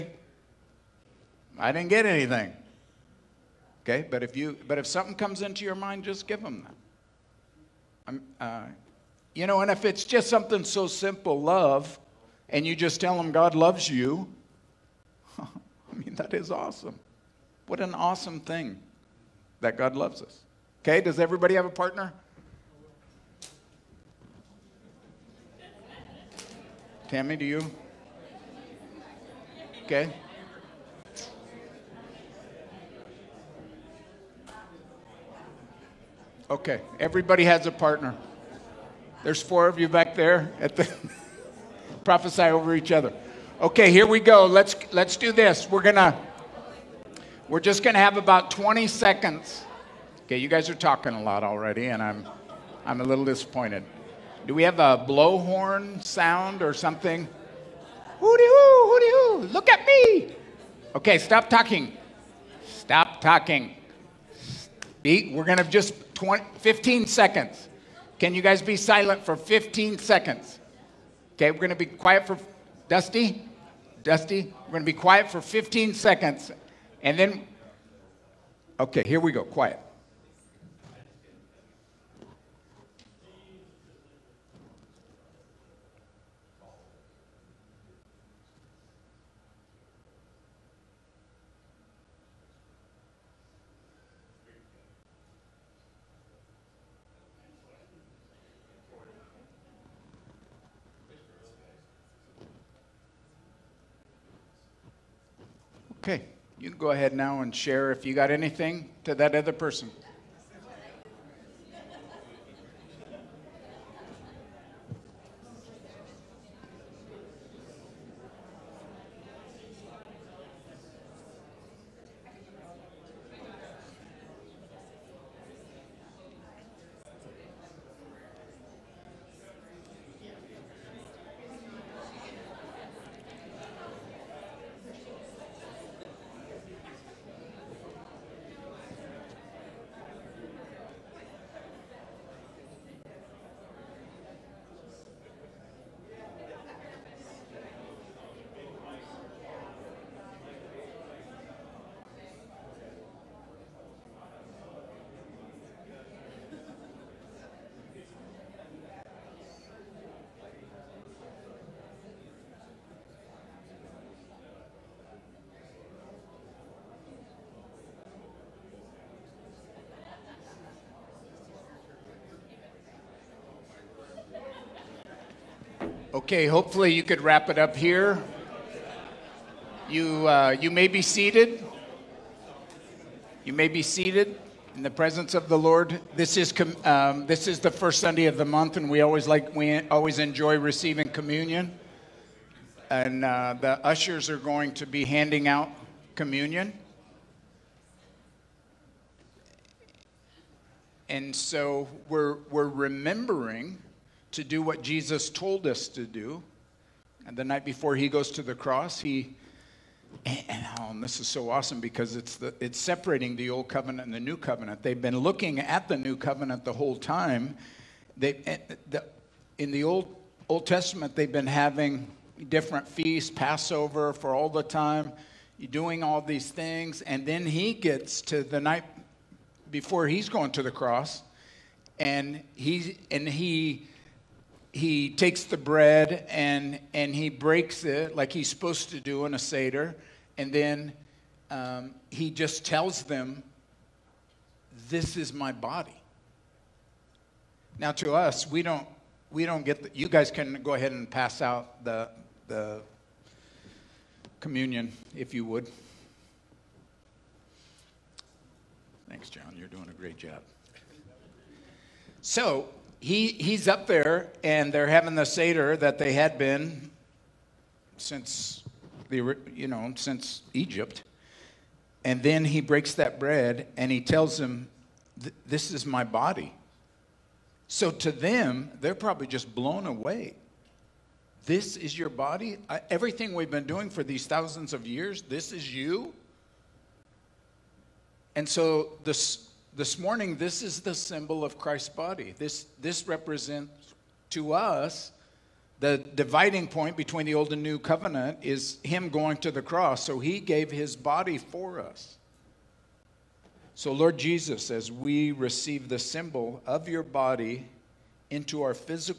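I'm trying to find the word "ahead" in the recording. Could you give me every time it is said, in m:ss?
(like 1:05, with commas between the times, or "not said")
1:46, 4:10.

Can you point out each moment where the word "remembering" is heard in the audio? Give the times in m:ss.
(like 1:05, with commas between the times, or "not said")
3:22.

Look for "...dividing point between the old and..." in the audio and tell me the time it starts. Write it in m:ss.
4:56.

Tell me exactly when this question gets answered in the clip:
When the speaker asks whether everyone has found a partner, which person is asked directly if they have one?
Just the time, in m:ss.
0:27.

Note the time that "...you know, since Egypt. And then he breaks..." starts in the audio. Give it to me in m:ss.
4:29.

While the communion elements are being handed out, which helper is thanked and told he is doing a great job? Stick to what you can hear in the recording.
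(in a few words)
John.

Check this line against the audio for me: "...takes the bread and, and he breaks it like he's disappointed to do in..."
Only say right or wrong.
wrong.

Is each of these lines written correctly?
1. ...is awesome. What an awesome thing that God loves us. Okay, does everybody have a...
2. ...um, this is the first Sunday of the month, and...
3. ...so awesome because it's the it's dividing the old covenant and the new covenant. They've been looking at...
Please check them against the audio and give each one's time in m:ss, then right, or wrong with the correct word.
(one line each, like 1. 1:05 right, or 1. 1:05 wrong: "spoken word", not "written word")
1. 0:16 right
2. 3:06 right
3. 3:31 wrong: "separating", not "dividing".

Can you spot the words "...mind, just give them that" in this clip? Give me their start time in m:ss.
0:05.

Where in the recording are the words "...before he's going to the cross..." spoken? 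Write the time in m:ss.
3:49.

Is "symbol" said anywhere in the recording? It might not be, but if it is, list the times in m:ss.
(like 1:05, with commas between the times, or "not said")
4:50, 5:05.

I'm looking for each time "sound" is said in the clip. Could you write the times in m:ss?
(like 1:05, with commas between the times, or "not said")
0:56.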